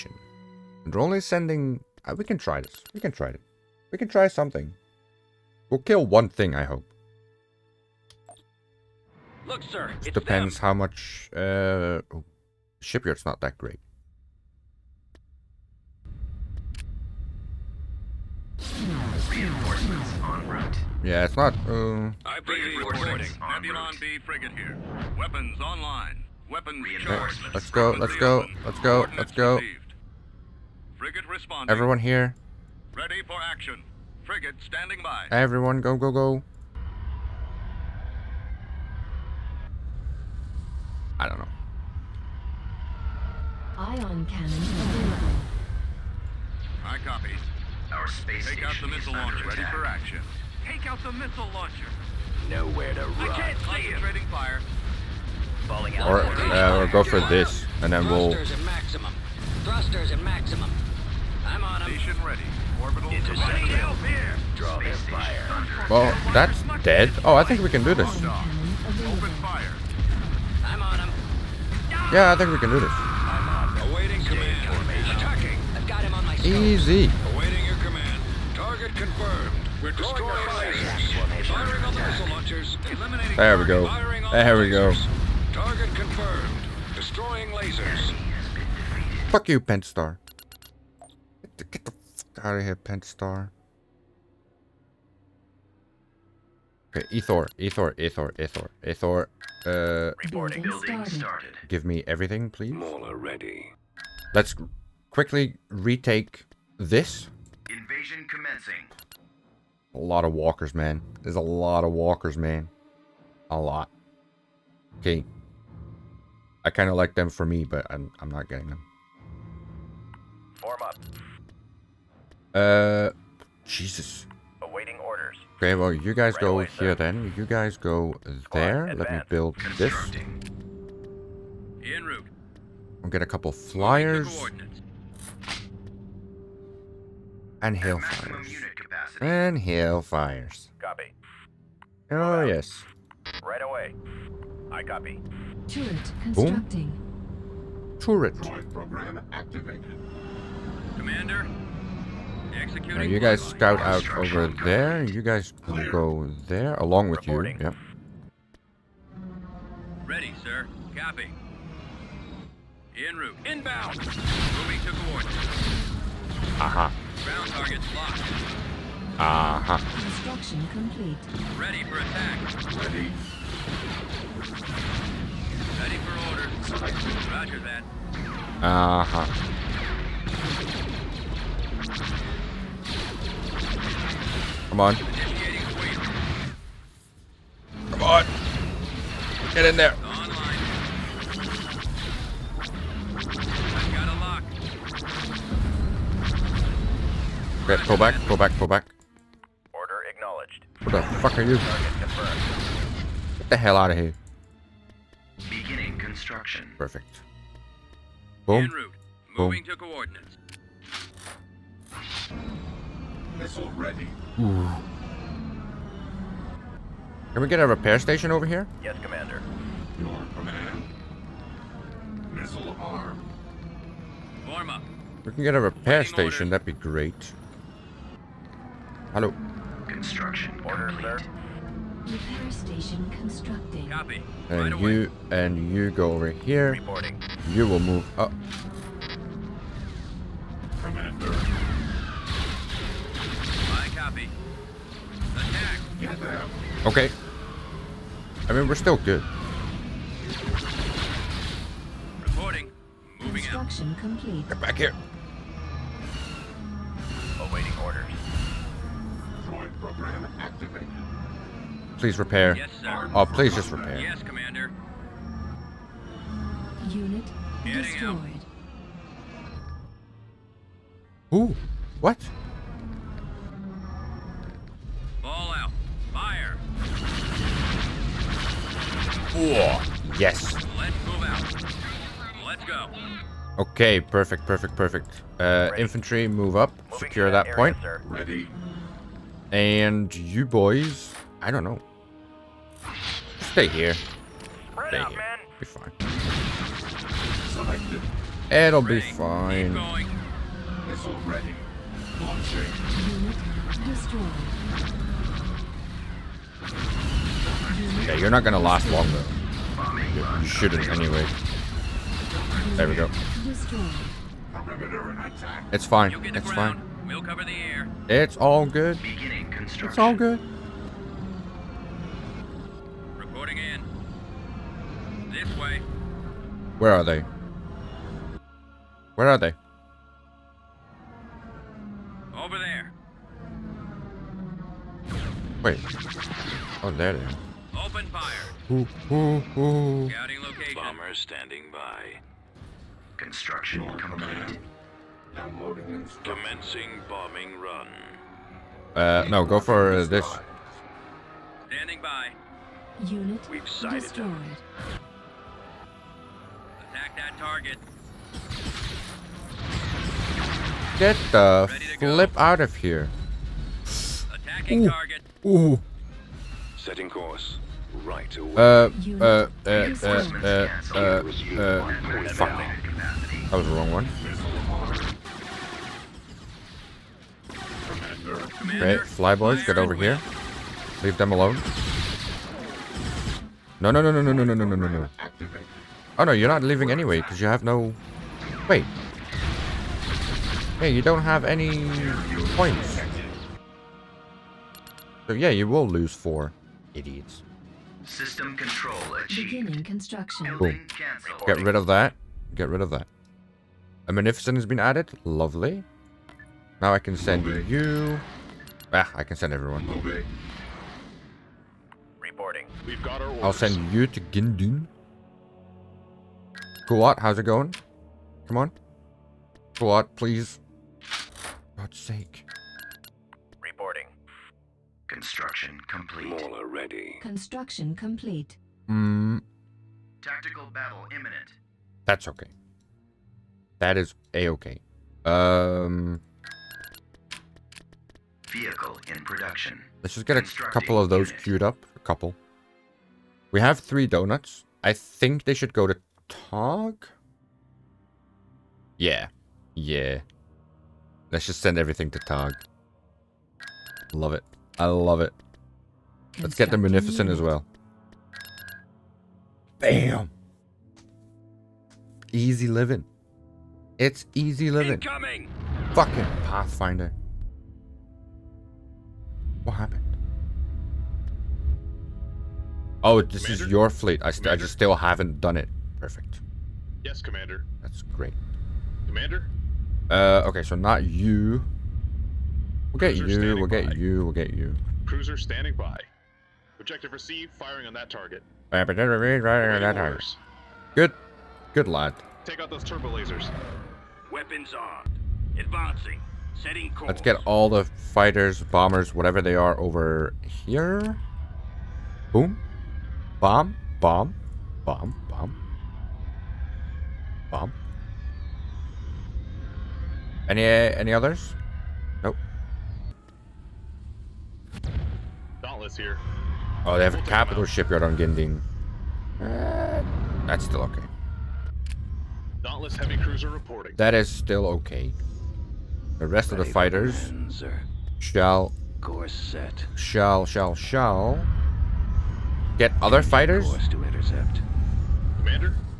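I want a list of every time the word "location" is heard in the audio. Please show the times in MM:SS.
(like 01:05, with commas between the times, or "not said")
05:40.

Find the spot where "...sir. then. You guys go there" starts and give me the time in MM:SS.
02:06.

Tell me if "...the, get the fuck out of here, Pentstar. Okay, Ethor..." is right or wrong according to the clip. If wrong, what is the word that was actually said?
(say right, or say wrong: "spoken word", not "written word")
right.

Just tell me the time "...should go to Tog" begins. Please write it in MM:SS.
07:25.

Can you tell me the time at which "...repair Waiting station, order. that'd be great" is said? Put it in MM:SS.
03:45.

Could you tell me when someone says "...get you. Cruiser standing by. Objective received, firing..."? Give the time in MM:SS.
08:04.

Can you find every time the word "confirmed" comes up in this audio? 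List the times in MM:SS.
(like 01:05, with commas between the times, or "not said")
01:18, 01:25.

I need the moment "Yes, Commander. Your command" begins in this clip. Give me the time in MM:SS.
03:38.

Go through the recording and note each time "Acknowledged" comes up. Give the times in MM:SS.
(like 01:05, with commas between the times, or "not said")
03:20.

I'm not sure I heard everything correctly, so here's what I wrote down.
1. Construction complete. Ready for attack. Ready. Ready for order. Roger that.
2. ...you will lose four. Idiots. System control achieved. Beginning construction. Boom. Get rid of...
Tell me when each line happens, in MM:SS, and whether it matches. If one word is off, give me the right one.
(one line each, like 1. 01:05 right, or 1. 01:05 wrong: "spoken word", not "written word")
1. 02:50 right
2. 06:35 right.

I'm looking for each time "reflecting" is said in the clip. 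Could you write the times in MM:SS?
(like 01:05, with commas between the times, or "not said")
not said.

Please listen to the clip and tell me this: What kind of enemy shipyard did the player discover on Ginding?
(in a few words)
Capital shipyard.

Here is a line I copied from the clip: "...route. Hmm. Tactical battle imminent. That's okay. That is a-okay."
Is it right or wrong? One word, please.
wrong.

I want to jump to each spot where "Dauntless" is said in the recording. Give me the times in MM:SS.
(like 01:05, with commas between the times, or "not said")
08:35, 08:42.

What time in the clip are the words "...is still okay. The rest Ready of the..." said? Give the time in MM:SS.
08:44.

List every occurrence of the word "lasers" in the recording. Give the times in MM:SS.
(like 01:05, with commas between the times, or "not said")
01:27, 08:13.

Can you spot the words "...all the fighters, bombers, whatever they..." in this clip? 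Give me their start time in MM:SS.
08:17.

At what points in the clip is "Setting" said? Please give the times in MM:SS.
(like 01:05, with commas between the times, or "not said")
06:06, 08:16.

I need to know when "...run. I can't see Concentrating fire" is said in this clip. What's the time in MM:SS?
00:53.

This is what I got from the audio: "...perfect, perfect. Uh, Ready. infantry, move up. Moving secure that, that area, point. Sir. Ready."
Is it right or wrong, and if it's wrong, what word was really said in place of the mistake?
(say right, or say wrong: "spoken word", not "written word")
right.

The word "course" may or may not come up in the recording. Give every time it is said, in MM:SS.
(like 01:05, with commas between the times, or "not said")
06:07, 08:16, 08:49, 08:53.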